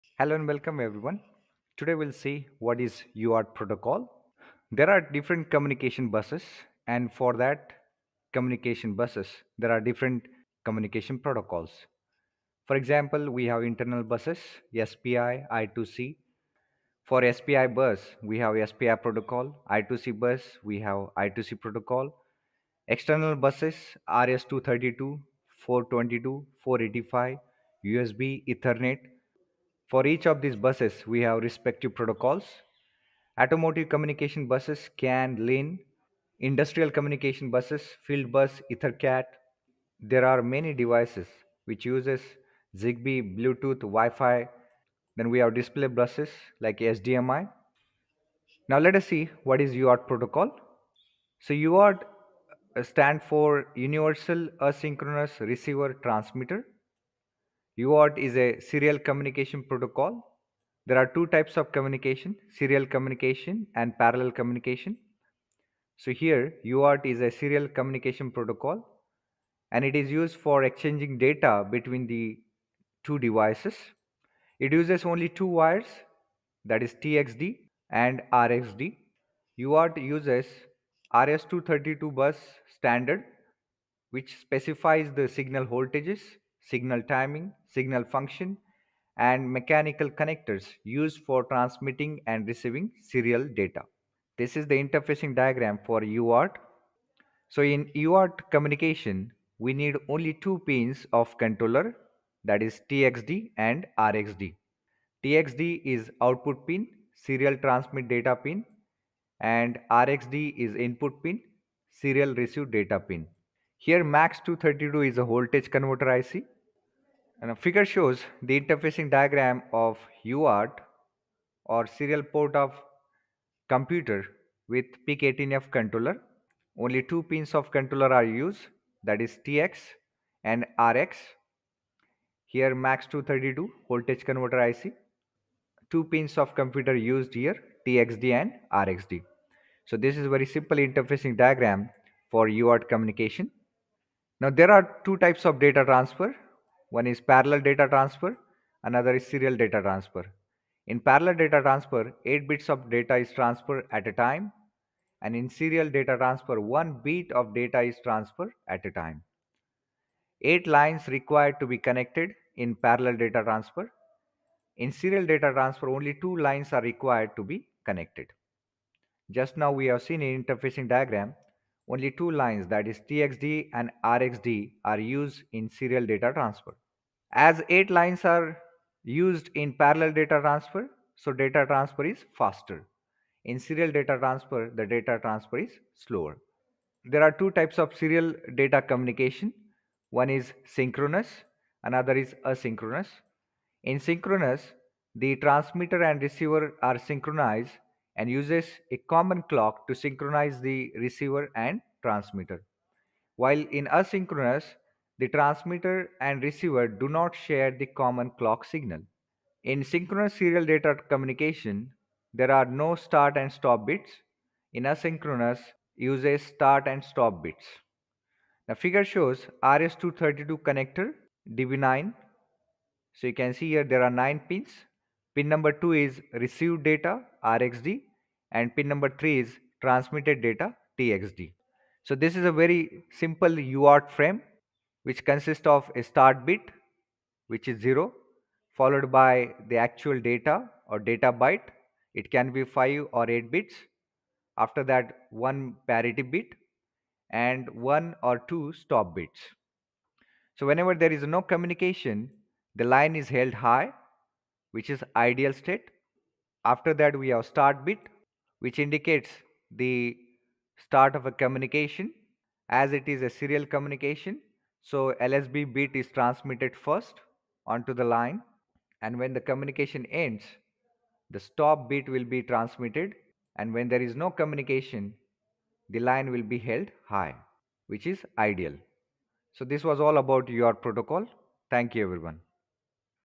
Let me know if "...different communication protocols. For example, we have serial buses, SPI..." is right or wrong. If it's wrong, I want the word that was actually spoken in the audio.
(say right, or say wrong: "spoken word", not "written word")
wrong: "internal", not "serial".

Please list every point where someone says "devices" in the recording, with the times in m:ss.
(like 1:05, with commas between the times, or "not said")
0:40, 1:13.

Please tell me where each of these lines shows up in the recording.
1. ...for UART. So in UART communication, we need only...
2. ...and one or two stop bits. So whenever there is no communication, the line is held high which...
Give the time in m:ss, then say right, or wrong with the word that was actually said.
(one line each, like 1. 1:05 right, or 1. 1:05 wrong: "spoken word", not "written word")
1. 1:35 right
2. 4:07 right.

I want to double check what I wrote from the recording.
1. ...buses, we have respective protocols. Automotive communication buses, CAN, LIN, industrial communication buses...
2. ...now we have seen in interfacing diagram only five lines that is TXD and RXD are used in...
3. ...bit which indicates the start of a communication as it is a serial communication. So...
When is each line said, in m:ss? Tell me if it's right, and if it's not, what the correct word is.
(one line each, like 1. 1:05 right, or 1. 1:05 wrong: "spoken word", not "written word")
1. 0:30 right
2. 2:49 wrong: "two", not "five"
3. 4:17 right.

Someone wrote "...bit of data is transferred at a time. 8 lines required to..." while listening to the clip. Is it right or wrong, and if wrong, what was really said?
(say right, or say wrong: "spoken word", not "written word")
right.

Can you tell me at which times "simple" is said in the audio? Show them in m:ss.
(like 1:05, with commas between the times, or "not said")
2:20, 3:53.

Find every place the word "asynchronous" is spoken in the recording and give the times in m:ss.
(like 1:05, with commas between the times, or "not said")
0:54, 3:12, 3:23, 3:34.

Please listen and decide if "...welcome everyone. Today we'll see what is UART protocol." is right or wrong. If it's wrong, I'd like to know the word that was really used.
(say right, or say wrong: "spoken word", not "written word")
right.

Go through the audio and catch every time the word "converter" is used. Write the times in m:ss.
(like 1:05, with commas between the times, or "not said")
1:55, 2:14.